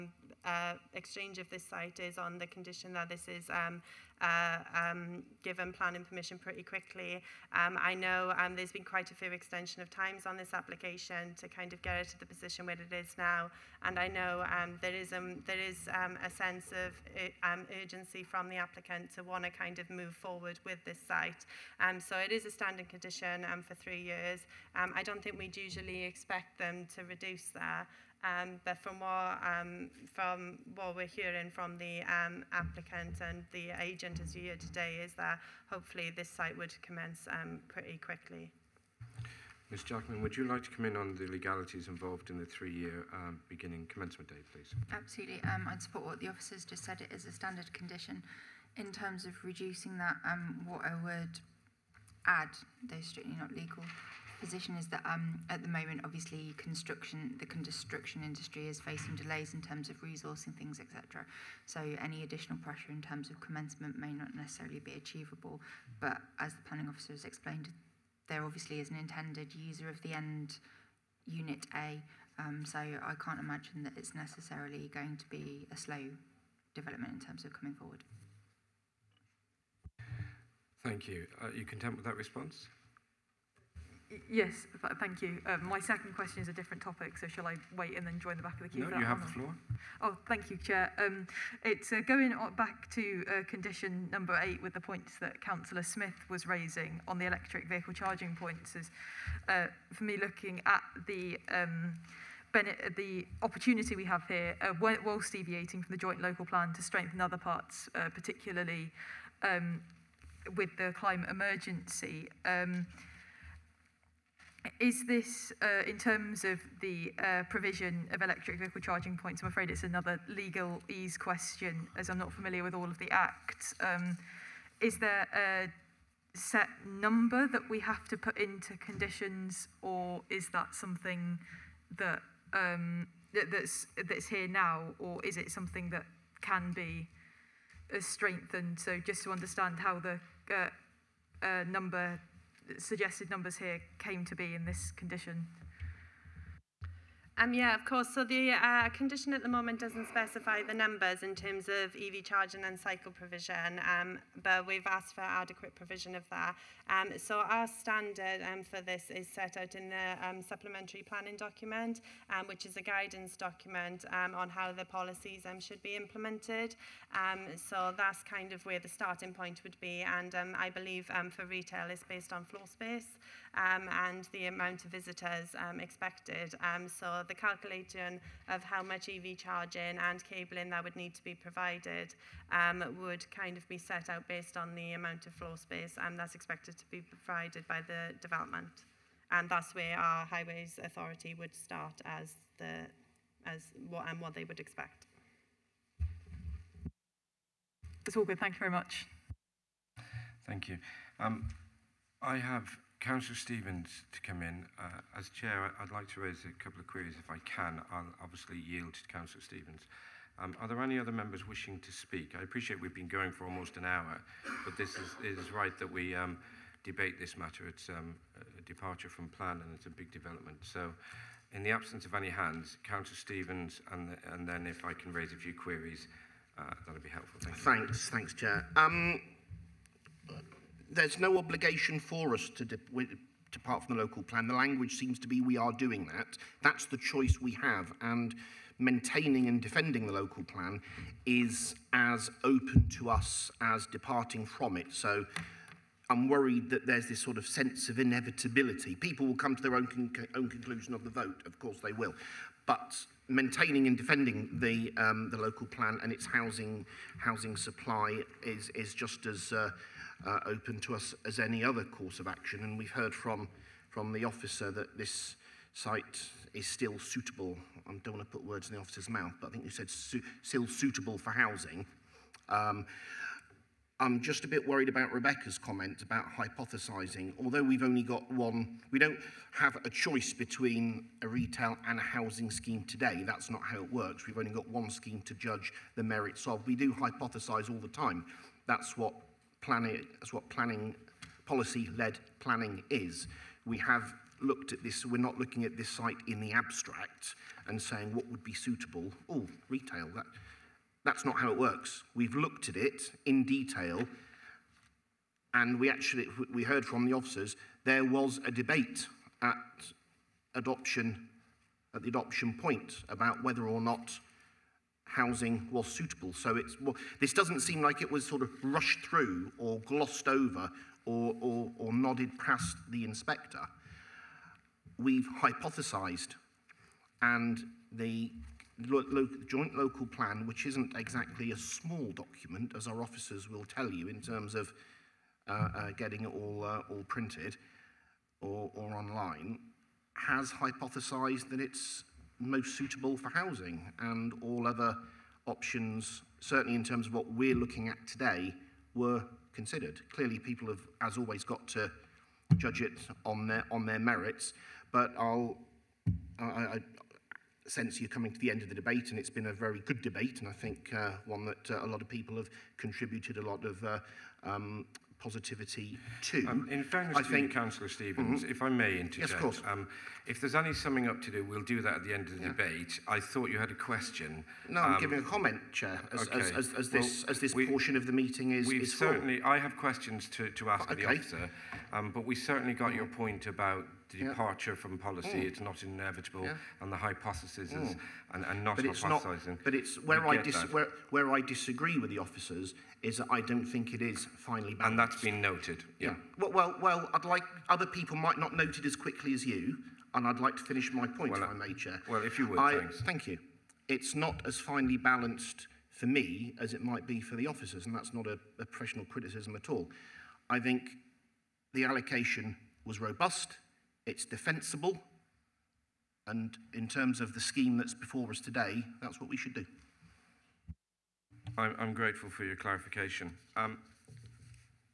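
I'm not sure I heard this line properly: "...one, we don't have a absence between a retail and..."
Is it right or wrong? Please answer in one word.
wrong.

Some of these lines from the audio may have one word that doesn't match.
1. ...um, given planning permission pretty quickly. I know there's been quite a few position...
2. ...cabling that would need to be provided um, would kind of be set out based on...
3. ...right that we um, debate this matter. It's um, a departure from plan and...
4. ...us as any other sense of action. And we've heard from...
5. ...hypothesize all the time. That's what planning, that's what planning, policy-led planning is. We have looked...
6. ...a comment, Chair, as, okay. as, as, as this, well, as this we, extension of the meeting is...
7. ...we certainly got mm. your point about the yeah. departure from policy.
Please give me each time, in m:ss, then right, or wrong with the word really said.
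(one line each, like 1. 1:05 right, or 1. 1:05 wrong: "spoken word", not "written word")
1. 0:04 wrong: "extension", not "position"
2. 3:00 right
3. 3:35 right
4. 4:20 wrong: "course", not "sense"
5. 4:46 right
6. 6:15 wrong: "portion", not "extension"
7. 6:22 right.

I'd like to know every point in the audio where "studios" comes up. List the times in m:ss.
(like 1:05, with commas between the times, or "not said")
not said.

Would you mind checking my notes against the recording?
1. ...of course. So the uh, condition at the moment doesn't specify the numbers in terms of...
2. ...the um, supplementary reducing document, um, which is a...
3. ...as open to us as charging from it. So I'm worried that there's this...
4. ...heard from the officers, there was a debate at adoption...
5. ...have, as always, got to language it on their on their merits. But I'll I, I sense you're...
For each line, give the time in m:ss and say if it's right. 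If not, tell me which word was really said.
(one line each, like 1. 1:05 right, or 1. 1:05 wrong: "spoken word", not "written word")
1. 2:27 right
2. 2:39 wrong: "planning", not "reducing"
3. 4:01 wrong: "departing", not "charging"
4. 5:06 right
5. 5:50 wrong: "judge", not "language".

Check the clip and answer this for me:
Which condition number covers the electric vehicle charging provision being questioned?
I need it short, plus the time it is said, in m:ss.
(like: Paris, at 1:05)
8, at 1:33.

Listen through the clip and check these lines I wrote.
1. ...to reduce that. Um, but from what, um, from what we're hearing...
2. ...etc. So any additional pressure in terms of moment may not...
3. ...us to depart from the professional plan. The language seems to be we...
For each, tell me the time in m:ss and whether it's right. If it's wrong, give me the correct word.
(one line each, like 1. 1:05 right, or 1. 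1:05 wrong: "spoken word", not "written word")
1. 0:26 right
2. 1:00 wrong: "commencement", not "moment"
3. 3:52 wrong: "local", not "professional".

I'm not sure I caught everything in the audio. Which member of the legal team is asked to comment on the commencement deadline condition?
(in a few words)
Ms Jackman.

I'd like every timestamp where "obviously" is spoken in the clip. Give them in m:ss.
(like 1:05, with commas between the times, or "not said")
0:56, 1:08, 3:28.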